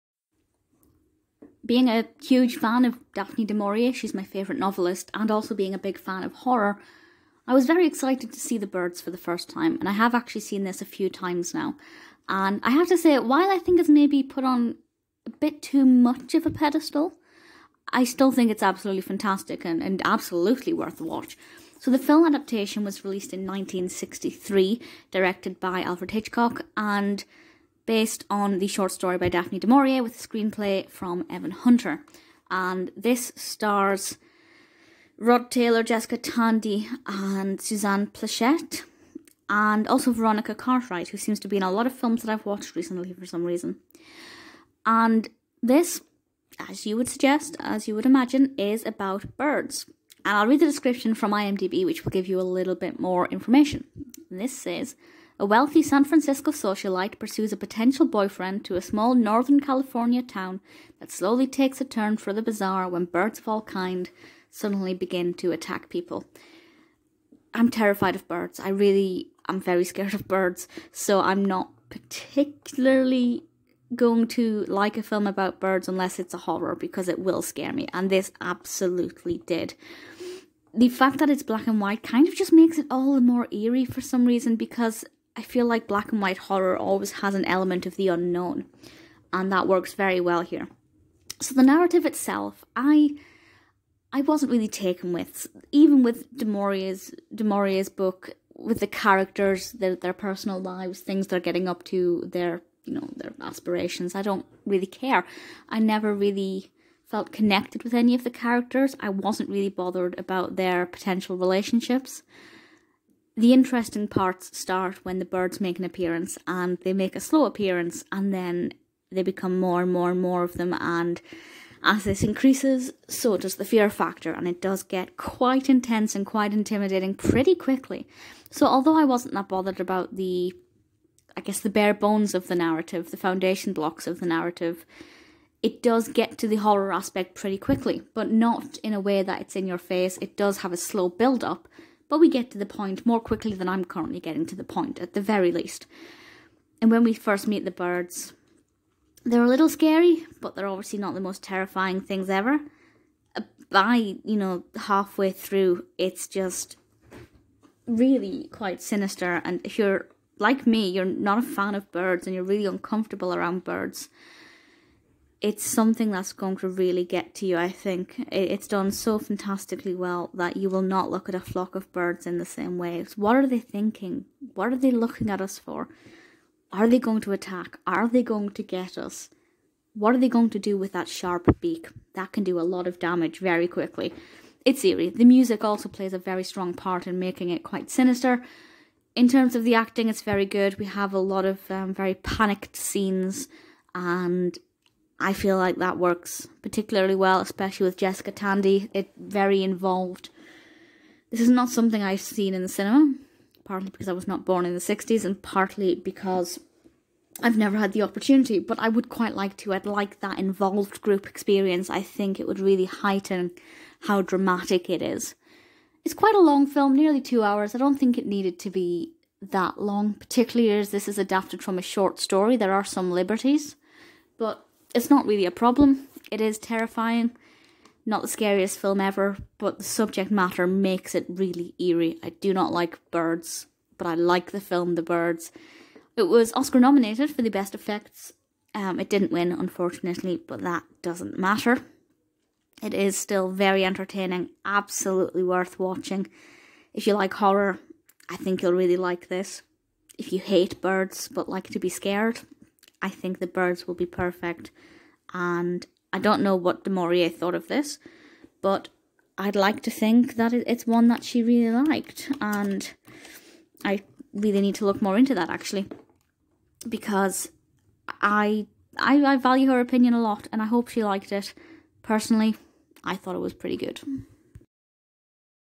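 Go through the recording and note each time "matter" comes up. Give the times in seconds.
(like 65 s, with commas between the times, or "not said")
230 s, 241 s.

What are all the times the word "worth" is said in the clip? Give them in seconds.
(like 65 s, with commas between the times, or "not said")
20 s, 245 s.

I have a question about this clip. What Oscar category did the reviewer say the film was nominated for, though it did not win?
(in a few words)
Best effects.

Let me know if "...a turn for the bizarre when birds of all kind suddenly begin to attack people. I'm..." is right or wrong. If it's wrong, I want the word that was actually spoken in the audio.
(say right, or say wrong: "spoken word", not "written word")
right.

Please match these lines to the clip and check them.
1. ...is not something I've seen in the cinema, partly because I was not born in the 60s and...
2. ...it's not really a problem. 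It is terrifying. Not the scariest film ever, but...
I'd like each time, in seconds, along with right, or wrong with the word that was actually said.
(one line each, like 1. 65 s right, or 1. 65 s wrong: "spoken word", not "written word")
1. 201 s right
2. 224 s right.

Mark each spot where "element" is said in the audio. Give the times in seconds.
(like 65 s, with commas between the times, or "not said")
87 s.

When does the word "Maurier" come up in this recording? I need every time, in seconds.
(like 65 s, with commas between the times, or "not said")
3 s, 29 s, 96 s, 256 s.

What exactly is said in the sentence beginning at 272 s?
Personally, I thought it was pretty good.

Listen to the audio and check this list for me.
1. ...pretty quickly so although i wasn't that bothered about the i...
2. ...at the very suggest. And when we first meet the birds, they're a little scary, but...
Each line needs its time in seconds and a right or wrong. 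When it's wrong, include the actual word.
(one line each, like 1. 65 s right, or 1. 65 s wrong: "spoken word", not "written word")
1. 127 s right
2. 144 s wrong: "least", not "suggest".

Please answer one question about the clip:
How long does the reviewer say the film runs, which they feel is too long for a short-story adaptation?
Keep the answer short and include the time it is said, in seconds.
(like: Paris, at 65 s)
nearly 2 hours, at 216 s.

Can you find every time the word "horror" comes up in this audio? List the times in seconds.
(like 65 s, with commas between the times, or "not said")
6 s, 76 s, 86 s, 136 s, 247 s.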